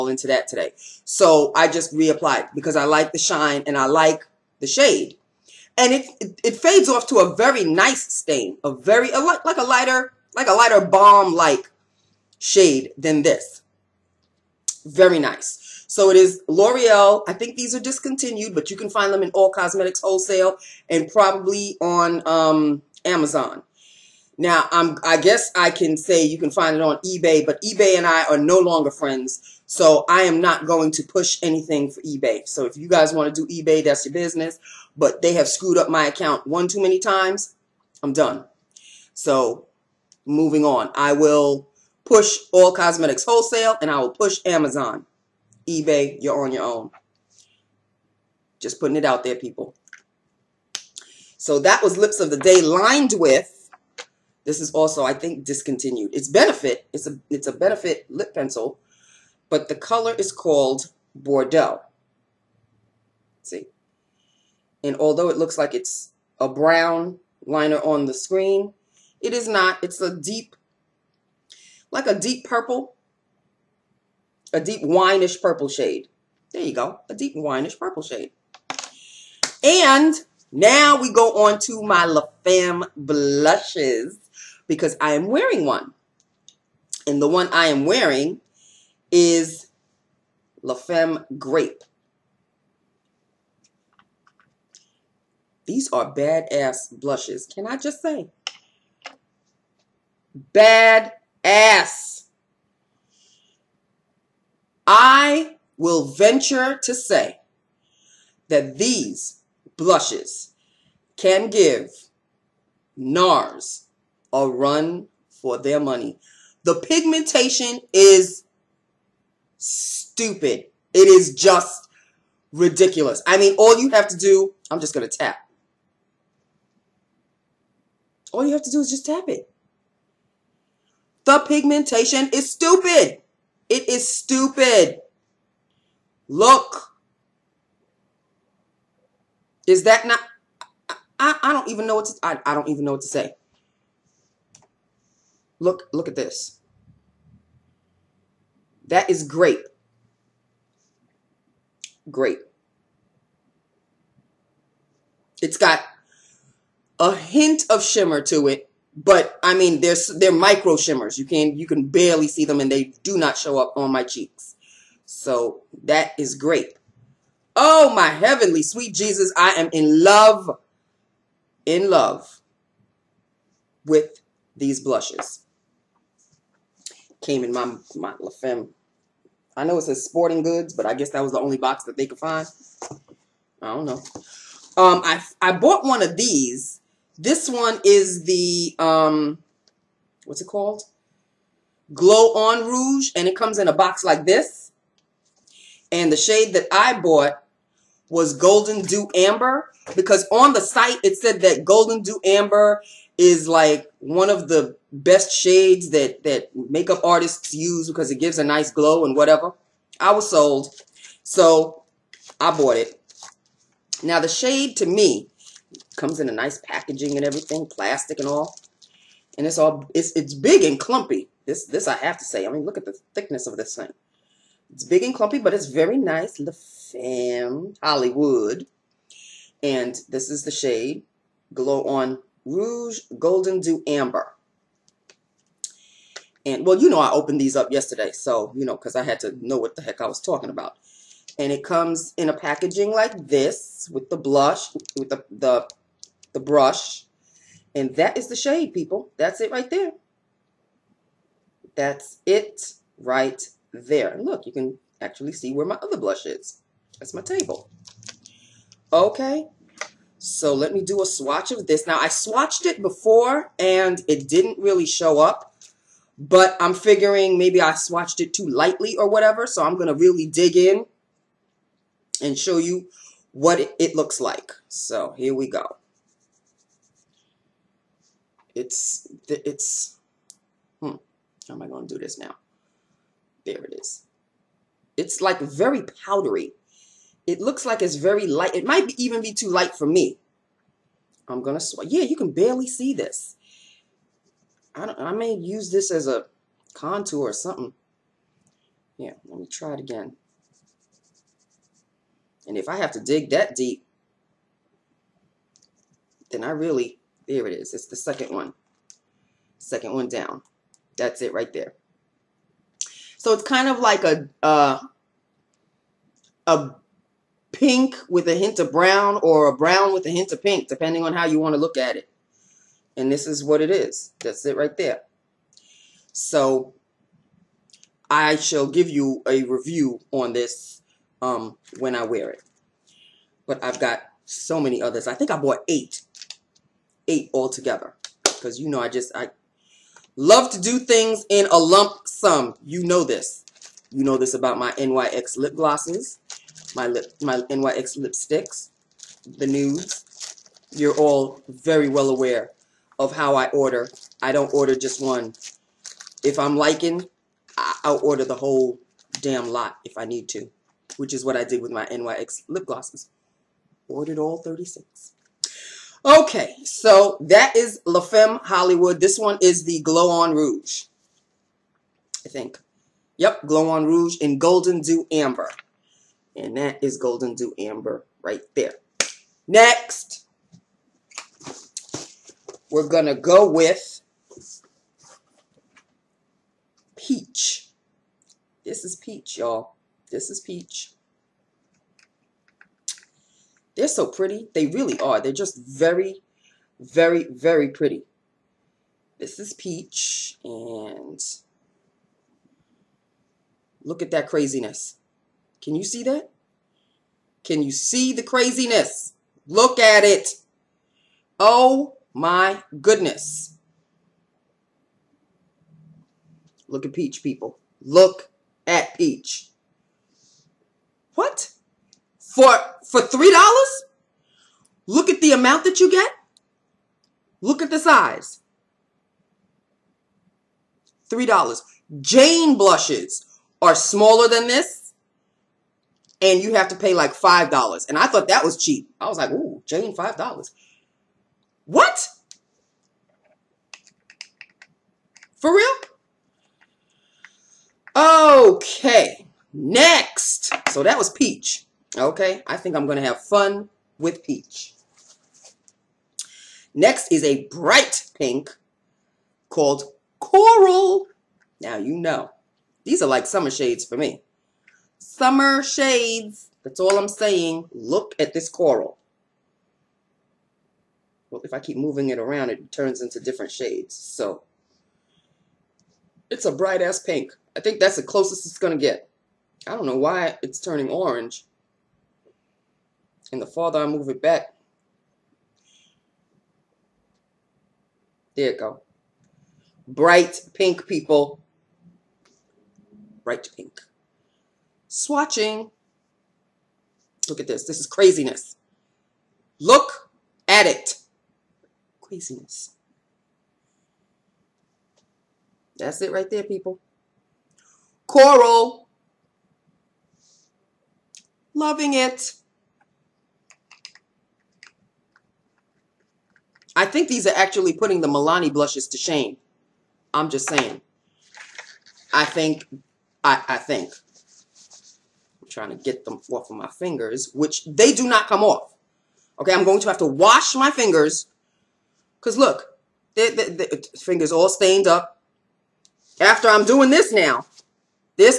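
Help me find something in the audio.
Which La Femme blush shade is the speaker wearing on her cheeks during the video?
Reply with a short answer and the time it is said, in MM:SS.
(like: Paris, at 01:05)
Grape, at 01:30.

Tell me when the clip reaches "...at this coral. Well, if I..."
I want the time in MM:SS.
07:48.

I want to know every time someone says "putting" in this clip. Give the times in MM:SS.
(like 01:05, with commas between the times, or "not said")
00:48, 08:37.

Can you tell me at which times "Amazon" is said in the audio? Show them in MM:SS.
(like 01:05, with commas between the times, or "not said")
00:23, 00:44.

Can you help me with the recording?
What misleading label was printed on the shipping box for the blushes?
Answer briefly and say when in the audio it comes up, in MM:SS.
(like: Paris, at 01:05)
Sporting Goods, at 03:00.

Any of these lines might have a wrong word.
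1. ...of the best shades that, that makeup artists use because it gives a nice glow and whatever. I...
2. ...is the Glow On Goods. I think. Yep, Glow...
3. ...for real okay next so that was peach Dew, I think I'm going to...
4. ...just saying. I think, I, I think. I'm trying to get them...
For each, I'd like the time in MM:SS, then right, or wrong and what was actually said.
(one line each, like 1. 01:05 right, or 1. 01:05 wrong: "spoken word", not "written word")
1. 03:24 right
2. 06:09 wrong: "Rouge", not "Goods"
3. 07:25 wrong: "Okay", not "Dew"
4. 08:40 right.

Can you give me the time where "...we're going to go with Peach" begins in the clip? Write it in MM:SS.
06:22.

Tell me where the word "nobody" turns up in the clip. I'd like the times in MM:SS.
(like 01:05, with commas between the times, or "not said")
not said.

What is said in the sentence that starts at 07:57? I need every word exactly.
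I think that's the closest it's going to get.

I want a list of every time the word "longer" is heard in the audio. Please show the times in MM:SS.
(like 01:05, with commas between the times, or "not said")
00:28.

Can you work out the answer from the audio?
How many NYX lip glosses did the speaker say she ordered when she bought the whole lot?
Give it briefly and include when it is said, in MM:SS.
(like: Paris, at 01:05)
36, at 06:04.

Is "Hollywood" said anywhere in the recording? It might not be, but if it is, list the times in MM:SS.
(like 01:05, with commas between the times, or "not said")
03:47, 06:08.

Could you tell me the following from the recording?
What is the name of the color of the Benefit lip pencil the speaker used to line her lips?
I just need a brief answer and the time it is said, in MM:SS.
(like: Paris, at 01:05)
Bordeaux, at 01:01.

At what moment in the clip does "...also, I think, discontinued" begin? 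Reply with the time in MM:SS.
00:54.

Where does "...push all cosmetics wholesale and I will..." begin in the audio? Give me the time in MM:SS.
00:42.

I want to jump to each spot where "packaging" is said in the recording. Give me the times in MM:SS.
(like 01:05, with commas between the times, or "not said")
03:36, 04:02.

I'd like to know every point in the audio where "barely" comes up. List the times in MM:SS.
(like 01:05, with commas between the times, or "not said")
02:41, 04:52.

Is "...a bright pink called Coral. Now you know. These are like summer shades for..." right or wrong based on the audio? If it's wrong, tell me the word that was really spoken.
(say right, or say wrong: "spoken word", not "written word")
right.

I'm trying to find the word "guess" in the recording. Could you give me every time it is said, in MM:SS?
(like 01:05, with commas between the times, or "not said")
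00:25, 03:00.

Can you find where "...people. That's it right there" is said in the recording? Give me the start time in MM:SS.
04:08.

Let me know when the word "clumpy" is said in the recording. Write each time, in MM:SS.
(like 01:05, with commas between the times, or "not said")
03:40, 03:45.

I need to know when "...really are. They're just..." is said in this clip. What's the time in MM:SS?
06:34.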